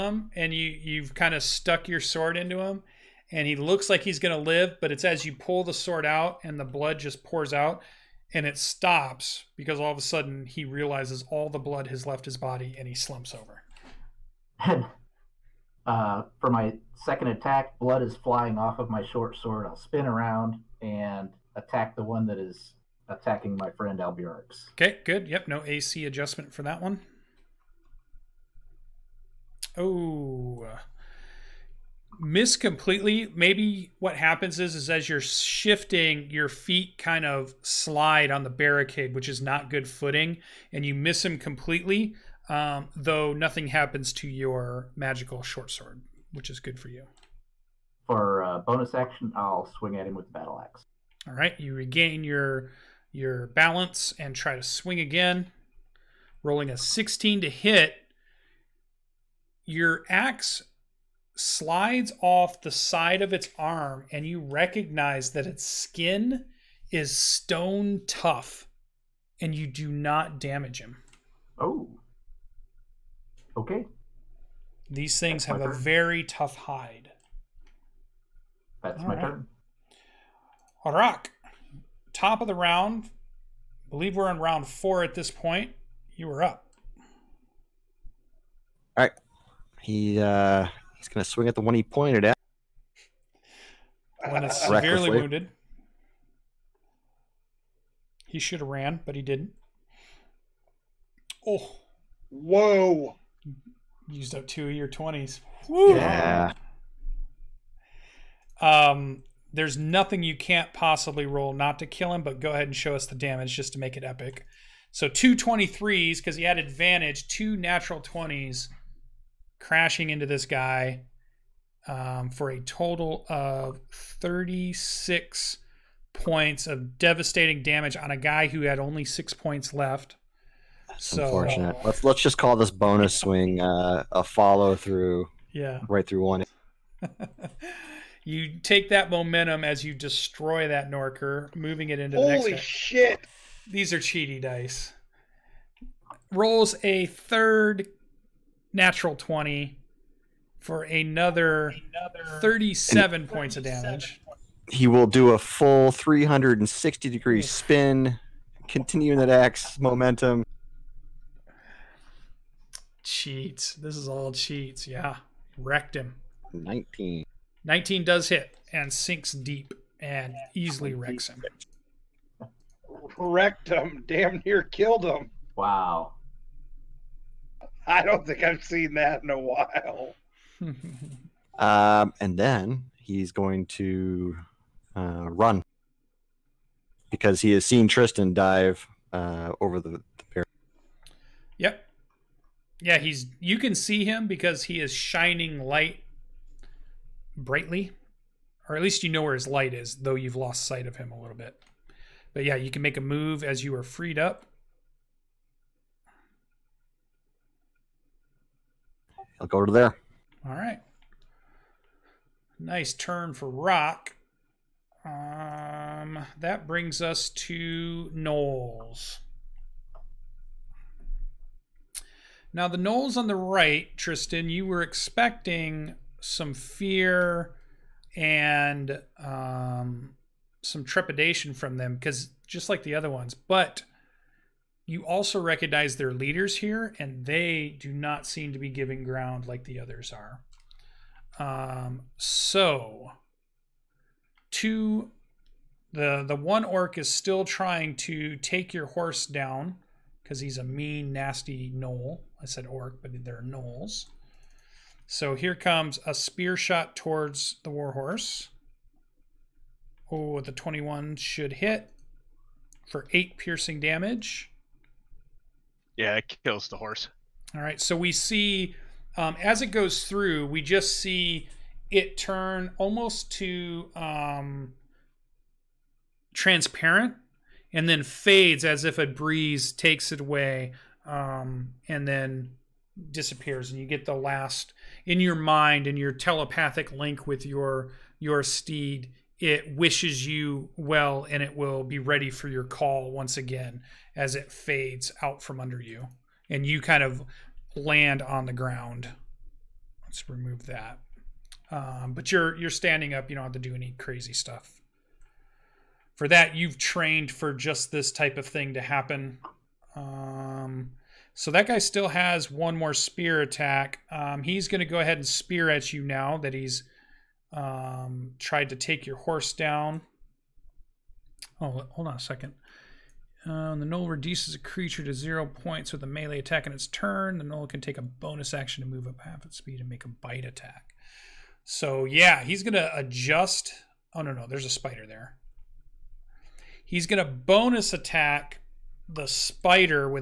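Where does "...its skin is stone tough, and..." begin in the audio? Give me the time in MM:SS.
01:05.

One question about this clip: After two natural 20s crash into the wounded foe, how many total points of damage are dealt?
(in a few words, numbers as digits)
36.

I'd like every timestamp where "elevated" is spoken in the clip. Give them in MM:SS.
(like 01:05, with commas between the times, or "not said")
not said.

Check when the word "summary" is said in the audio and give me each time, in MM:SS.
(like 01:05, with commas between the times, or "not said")
not said.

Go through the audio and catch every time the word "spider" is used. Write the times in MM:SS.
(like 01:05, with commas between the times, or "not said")
05:34, 05:39.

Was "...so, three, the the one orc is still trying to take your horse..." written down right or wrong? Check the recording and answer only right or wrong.
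wrong.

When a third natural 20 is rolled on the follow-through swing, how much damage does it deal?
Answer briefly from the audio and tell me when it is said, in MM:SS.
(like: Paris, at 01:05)
37, at 02:32.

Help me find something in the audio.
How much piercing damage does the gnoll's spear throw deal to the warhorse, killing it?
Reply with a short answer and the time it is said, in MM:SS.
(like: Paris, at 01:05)
8, at 04:23.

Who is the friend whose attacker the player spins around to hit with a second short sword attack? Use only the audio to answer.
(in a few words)
Alberix.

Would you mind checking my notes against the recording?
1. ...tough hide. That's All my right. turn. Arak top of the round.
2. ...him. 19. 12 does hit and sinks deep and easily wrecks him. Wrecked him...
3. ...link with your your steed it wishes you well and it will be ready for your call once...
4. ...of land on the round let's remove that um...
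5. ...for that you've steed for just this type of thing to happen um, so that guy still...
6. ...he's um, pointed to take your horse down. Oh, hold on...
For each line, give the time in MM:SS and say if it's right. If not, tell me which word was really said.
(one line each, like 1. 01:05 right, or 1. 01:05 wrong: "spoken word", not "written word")
1. 01:16 right
2. 02:45 wrong: "19", not "12"
3. 04:46 right
4. 04:57 wrong: "ground", not "round"
5. 05:06 wrong: "trained", not "steed"
6. 05:16 wrong: "tried", not "pointed".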